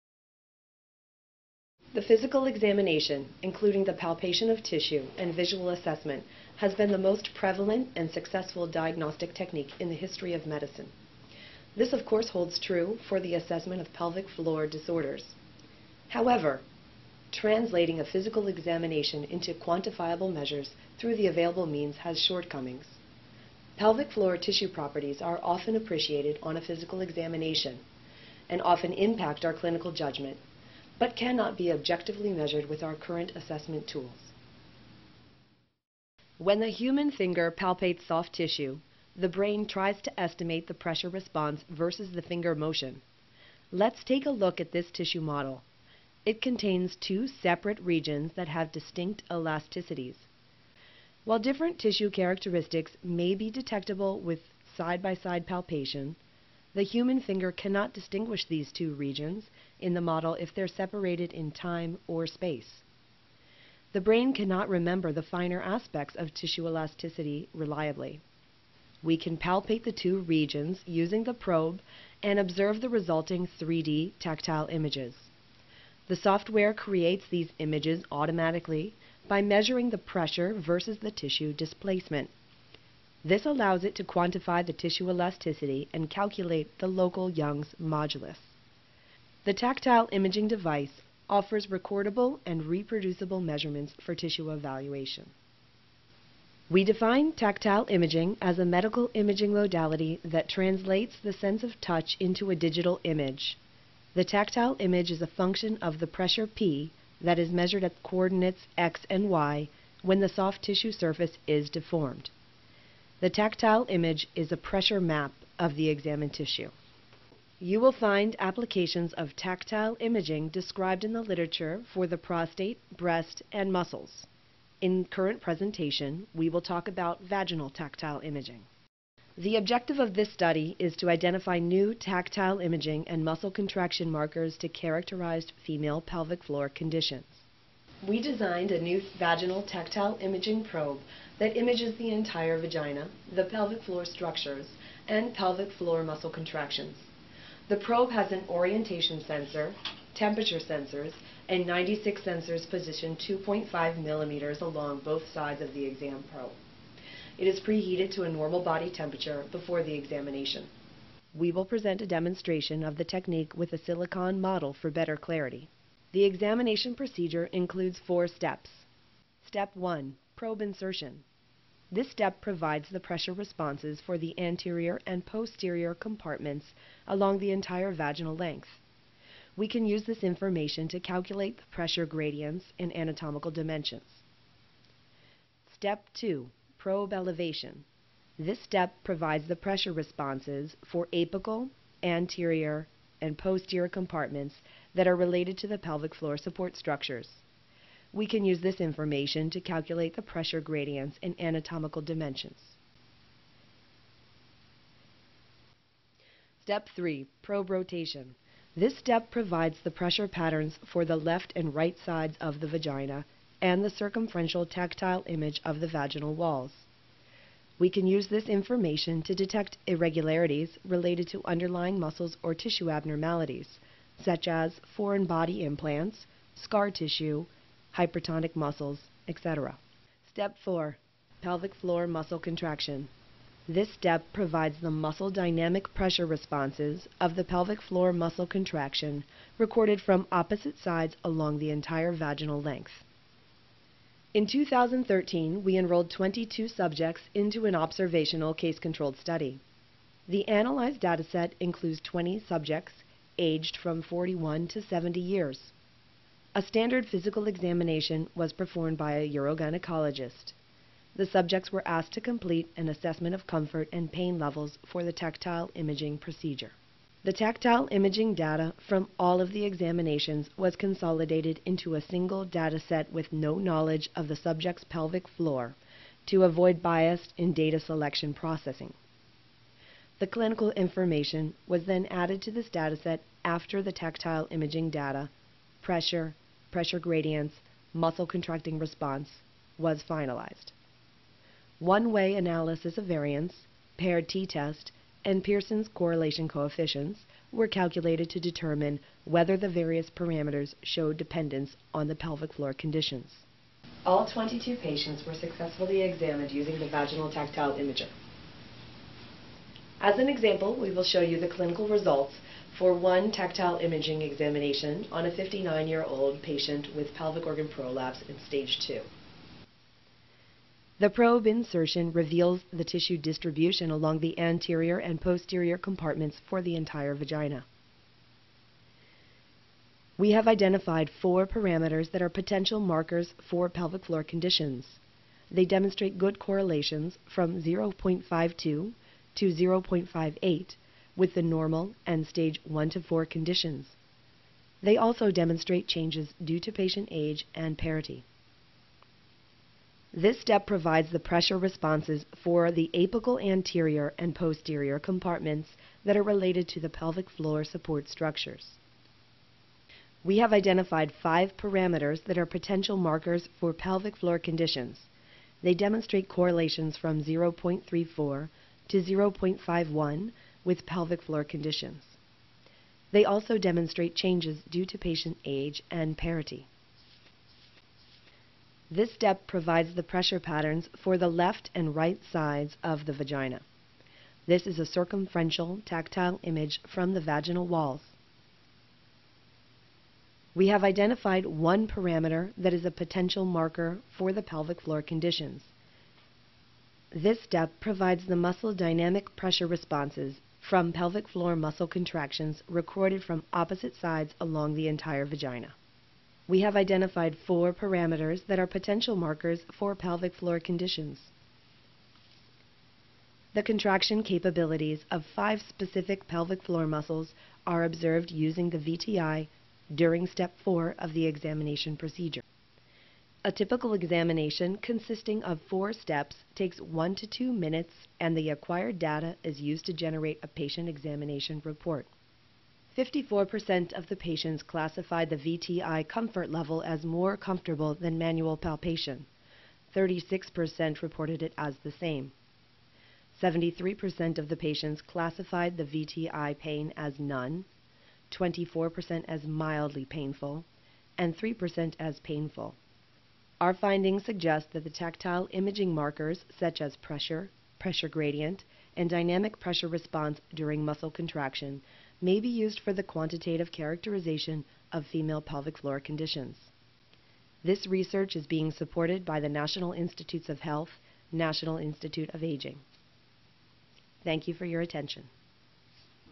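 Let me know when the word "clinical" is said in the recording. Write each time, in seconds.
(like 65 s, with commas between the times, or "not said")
29 s, 280 s, 311 s.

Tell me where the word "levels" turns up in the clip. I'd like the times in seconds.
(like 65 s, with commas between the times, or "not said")
264 s, 436 s.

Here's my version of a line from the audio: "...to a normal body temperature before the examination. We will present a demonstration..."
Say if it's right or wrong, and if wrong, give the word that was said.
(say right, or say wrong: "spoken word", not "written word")
right.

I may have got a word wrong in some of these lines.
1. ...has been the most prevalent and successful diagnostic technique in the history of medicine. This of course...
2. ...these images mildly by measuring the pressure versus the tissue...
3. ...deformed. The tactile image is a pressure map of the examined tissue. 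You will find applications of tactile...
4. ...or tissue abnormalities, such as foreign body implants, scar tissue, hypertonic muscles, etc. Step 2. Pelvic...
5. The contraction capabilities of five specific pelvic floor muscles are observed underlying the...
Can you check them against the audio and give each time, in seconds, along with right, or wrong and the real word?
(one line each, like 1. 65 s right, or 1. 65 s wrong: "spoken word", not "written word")
1. 6 s right
2. 77 s wrong: "automatically", not "mildly"
3. 111 s right
4. 222 s wrong: "4", not "2"
5. 413 s wrong: "using", not "underlying".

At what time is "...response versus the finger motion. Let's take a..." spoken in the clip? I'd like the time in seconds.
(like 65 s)
41 s.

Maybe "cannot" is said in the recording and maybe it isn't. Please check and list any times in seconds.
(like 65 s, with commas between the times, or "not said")
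31 s, 57 s, 64 s.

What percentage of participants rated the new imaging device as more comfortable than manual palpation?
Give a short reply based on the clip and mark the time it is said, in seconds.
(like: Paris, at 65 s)
54%, at 432 s.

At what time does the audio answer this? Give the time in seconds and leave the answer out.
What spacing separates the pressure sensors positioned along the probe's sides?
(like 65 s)
153 s.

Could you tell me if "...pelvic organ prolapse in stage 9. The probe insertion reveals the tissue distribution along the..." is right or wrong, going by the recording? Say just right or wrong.
wrong.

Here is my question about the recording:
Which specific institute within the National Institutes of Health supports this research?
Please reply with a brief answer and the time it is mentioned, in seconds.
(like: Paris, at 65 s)
National Institute of Aging, at 471 s.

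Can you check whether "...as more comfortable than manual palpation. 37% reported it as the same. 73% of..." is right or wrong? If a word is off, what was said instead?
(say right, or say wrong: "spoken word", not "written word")
wrong: "36", not "37".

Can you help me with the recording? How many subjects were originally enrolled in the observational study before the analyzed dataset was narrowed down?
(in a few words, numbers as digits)
22.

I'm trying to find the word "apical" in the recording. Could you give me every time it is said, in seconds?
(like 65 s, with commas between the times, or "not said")
191 s, 352 s.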